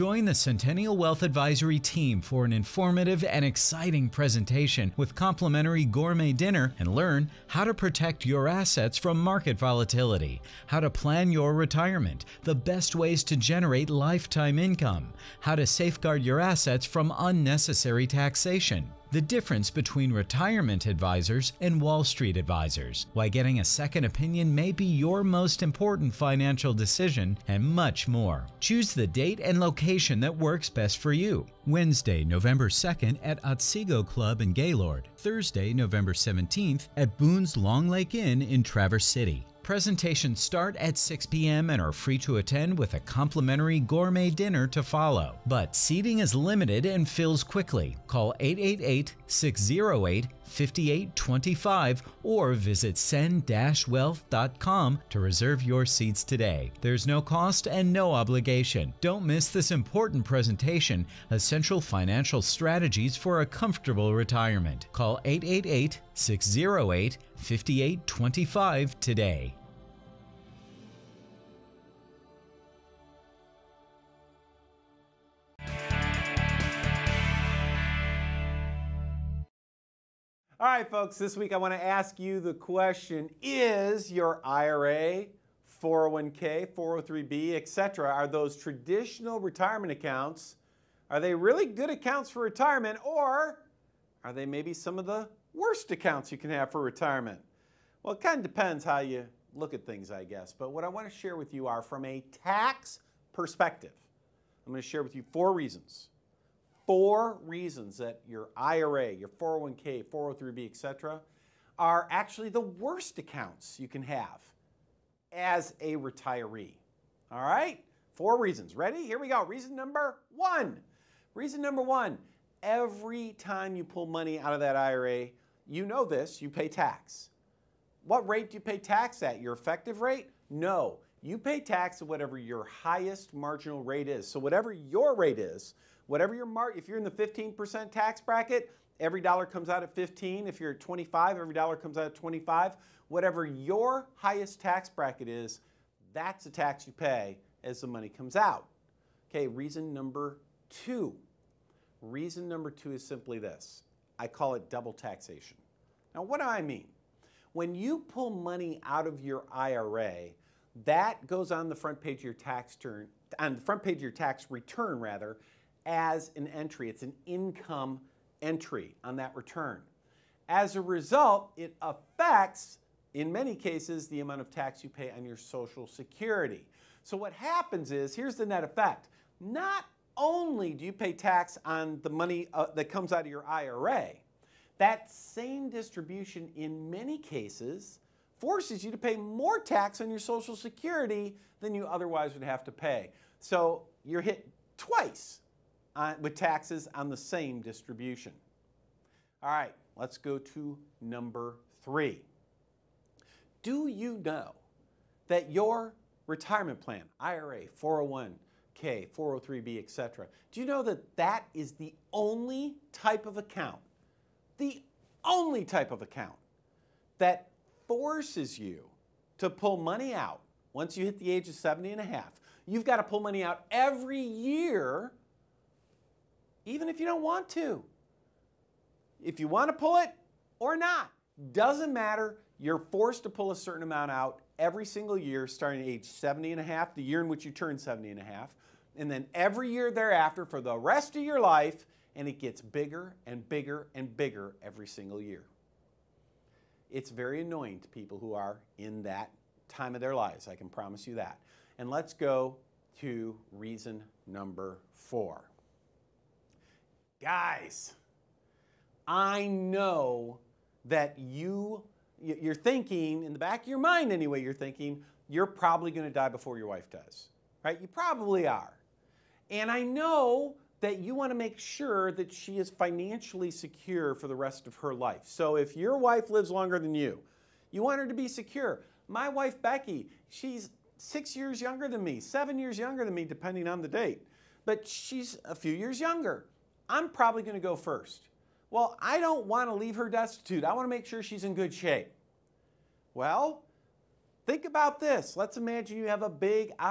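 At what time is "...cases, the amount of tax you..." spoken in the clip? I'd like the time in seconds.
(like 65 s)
173 s.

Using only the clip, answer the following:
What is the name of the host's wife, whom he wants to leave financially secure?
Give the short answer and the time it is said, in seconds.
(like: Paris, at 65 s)
Becky, at 279 s.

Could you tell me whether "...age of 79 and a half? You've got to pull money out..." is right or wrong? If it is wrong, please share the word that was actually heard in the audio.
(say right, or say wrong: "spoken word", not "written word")
wrong: "70", not "79".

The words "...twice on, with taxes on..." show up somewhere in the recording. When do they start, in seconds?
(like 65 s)
194 s.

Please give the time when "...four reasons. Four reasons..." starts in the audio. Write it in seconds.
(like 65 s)
105 s.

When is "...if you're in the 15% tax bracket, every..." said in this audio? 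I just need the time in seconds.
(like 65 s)
136 s.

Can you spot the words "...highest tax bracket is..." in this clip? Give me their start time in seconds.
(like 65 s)
144 s.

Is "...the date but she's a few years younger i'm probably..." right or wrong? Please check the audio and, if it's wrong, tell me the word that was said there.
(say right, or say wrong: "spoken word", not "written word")
right.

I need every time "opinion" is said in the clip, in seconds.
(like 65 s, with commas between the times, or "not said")
24 s.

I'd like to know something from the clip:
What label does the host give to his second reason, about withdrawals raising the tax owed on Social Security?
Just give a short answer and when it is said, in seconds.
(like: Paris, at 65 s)
Double taxation, at 154 s.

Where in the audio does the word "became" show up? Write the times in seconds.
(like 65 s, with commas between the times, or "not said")
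not said.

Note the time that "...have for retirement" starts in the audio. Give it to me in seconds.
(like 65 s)
96 s.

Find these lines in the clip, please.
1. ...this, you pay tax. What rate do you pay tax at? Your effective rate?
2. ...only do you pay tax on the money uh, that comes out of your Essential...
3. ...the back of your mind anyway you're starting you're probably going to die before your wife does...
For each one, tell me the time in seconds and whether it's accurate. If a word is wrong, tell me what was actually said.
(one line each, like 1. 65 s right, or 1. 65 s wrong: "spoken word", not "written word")
1. 126 s right
2. 180 s wrong: "IRA", not "Essential"
3. 263 s wrong: "thinking", not "starting".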